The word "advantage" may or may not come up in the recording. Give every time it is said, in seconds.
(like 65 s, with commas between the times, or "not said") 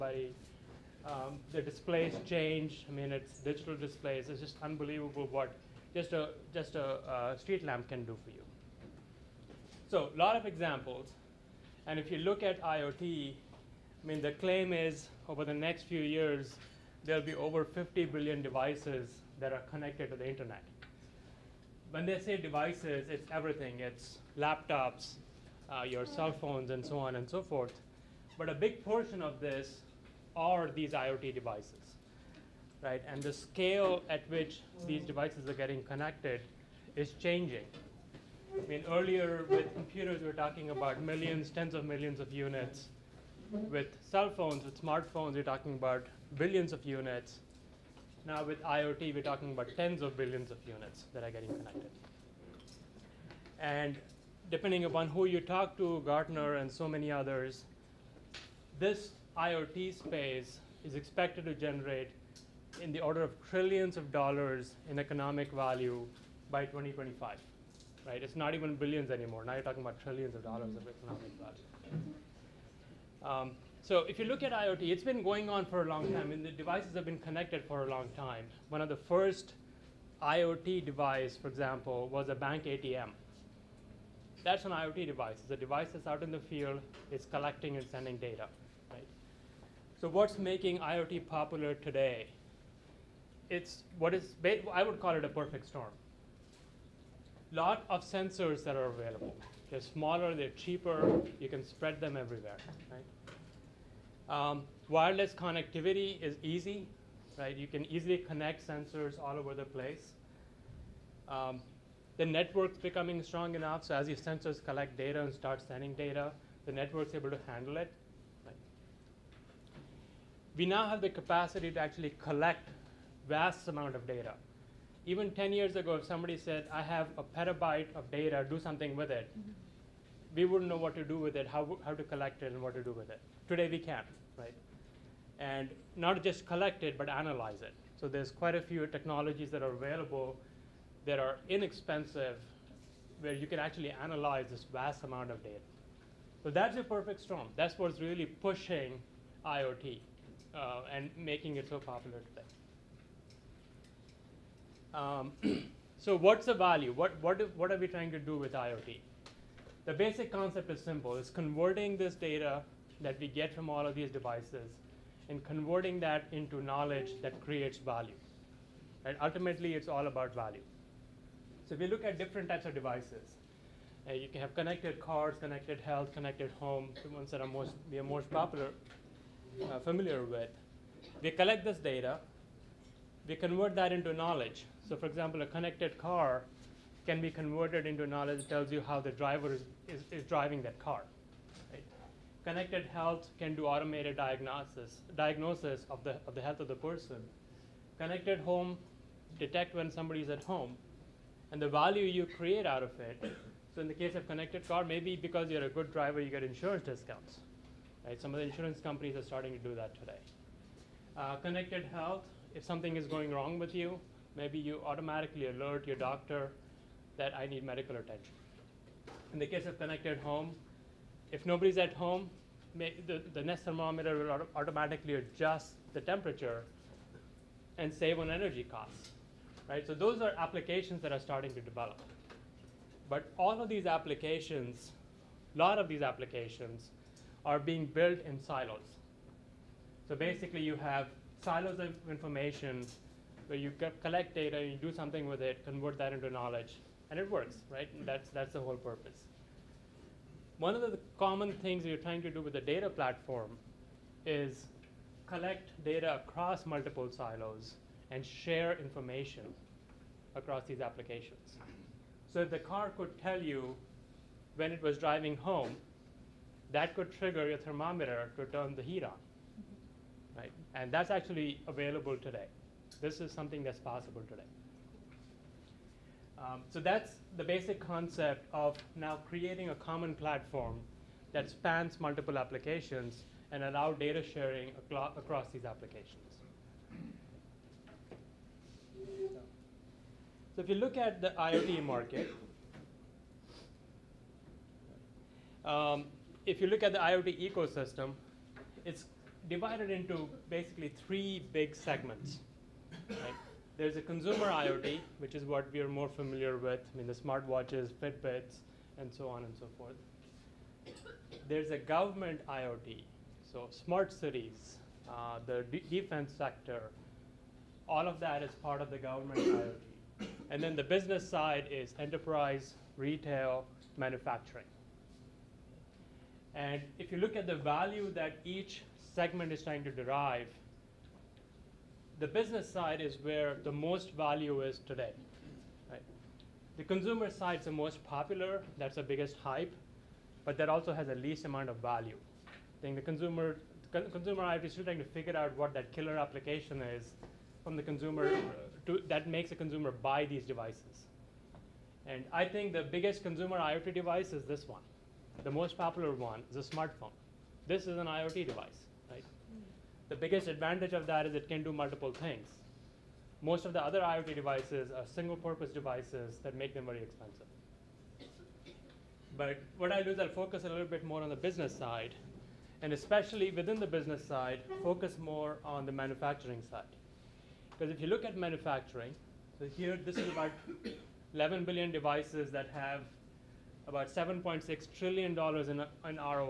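360 s.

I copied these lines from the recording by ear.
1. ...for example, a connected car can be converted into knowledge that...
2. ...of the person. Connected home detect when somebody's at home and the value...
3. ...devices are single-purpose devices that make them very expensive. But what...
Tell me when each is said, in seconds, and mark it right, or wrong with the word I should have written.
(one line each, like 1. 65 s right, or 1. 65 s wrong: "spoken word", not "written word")
1. 184 s right
2. 196 s right
3. 364 s right.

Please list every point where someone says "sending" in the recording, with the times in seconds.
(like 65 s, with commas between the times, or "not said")
87 s, 115 s.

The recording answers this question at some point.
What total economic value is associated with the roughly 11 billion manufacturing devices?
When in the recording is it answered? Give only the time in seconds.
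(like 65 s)
384 s.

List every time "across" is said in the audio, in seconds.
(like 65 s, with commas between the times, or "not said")
256 s, 260 s, 284 s.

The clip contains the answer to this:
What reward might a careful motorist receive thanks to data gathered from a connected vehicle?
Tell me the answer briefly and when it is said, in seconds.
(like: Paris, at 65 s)
insurance discounts, at 206 s.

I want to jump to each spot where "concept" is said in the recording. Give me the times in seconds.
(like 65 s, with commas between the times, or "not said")
160 s, 277 s.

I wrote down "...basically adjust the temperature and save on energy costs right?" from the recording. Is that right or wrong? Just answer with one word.
wrong.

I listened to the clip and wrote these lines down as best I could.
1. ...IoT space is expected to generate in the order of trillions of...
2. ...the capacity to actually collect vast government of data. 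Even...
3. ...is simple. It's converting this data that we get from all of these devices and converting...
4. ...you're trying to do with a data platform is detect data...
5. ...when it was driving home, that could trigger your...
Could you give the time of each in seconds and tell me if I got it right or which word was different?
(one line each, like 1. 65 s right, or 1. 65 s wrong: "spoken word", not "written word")
1. 59 s right
2. 121 s wrong: "amount", not "government"
3. 160 s right
4. 251 s wrong: "collect", not "detect"
5. 264 s right.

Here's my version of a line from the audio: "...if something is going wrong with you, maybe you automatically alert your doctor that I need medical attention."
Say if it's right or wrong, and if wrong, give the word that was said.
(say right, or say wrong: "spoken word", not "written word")
right.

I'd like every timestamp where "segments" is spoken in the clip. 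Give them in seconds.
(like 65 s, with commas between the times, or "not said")
301 s, 329 s.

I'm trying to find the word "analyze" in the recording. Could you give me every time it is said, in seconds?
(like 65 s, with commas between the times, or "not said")
137 s, 144 s.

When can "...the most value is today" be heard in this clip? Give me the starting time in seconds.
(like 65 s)
333 s.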